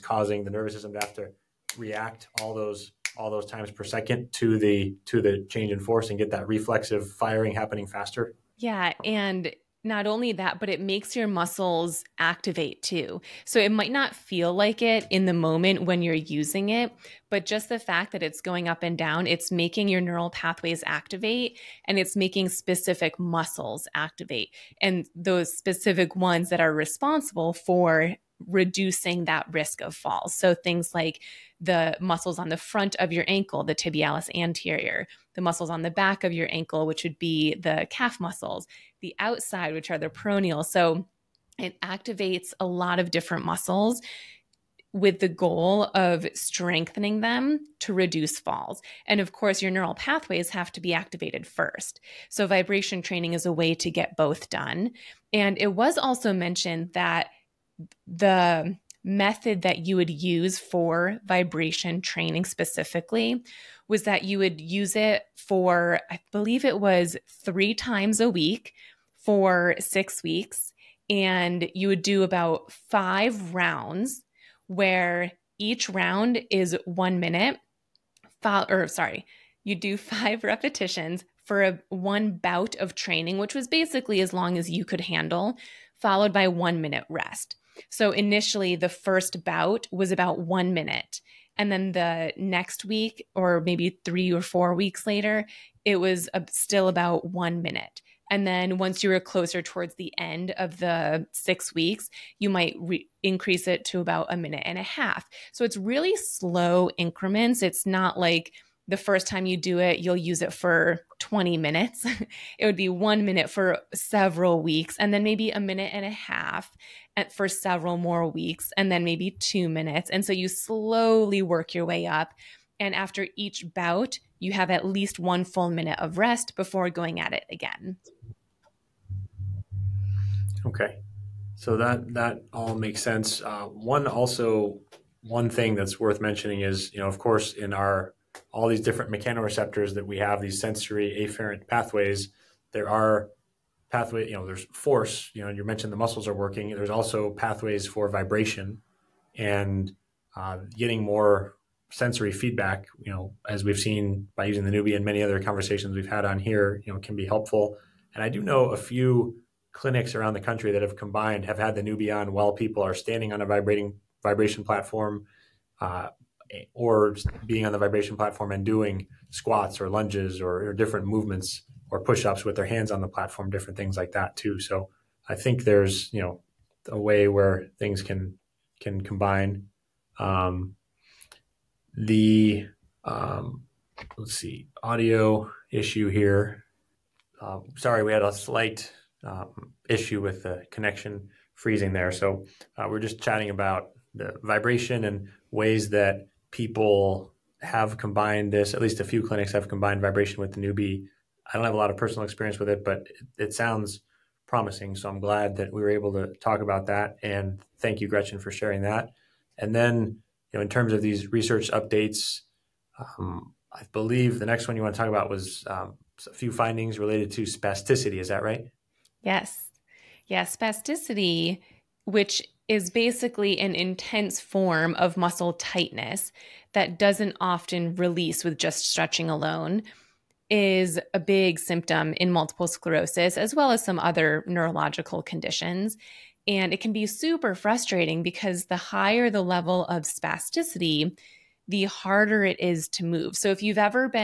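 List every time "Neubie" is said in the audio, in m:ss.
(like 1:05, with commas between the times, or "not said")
2:34, 2:41, 3:20.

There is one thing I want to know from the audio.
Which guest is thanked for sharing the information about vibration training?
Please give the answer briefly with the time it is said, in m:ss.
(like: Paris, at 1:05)
Gretchen, at 3:28.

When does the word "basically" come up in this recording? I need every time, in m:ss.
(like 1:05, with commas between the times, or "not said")
1:23, 3:42.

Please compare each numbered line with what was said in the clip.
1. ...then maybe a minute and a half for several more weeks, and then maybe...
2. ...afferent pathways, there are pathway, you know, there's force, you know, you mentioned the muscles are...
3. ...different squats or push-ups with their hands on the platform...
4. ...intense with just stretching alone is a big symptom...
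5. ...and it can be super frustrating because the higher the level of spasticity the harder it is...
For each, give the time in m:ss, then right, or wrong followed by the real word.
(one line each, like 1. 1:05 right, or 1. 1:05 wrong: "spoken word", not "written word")
1. 1:55 right
2. 2:21 right
3. 2:50 wrong: "movements", not "squats"
4. 3:47 wrong: "release", not "intense"
5. 3:56 right.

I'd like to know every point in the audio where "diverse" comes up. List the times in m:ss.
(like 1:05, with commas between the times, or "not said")
not said.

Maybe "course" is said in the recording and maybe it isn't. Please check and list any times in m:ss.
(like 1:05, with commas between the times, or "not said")
0:49, 2:17.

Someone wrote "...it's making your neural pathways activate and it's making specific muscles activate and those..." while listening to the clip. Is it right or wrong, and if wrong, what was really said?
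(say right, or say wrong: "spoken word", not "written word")
right.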